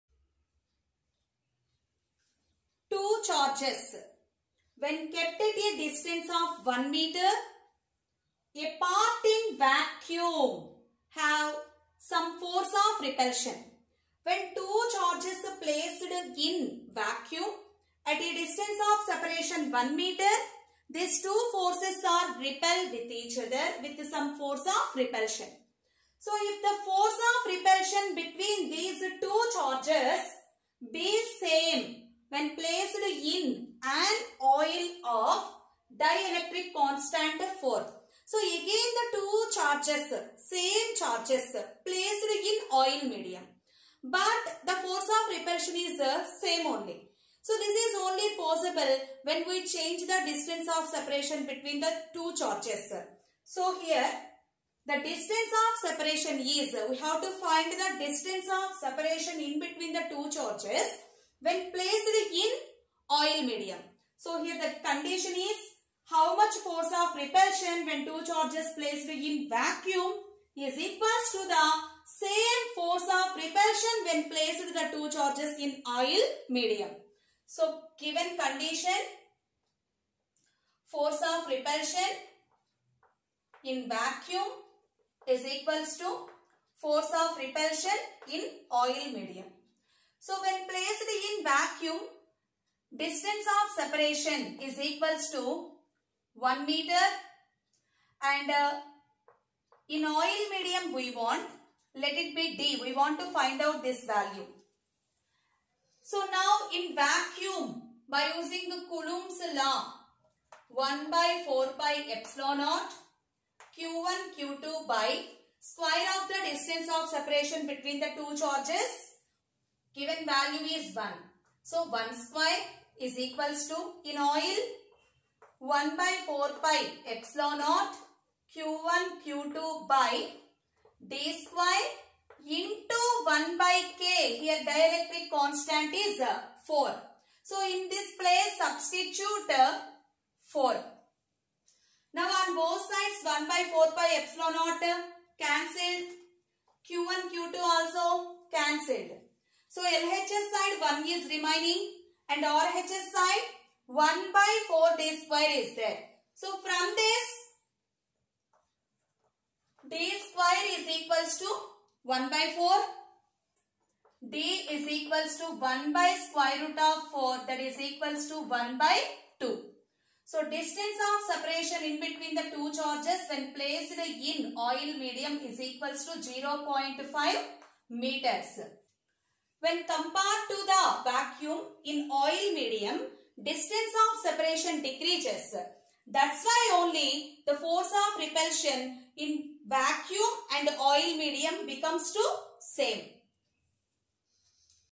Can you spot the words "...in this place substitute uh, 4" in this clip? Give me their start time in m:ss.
2:17.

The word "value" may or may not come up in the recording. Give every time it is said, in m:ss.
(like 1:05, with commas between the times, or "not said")
1:44, 2:00.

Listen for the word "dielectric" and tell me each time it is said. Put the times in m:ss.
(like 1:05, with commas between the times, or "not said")
0:36, 2:14.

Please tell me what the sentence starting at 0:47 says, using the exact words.
So this is only possible when we change the distance of separation between the two charges.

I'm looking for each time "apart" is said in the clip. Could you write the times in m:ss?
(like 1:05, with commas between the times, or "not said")
0:08.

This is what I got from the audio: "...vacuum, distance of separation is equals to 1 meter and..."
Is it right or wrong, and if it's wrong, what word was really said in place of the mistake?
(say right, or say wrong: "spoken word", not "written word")
right.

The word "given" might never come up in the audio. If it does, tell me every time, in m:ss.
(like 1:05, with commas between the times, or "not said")
1:17, 1:59.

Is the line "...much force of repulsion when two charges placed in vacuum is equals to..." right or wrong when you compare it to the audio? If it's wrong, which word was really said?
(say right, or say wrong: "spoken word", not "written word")
right.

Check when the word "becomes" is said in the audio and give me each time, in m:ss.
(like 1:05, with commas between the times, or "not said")
3:11.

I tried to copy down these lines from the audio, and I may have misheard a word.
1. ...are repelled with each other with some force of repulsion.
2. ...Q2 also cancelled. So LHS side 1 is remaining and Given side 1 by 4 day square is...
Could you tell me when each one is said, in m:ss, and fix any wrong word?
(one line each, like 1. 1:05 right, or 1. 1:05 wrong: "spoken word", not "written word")
1. 0:22 right
2. 2:27 wrong: "RHS", not "Given".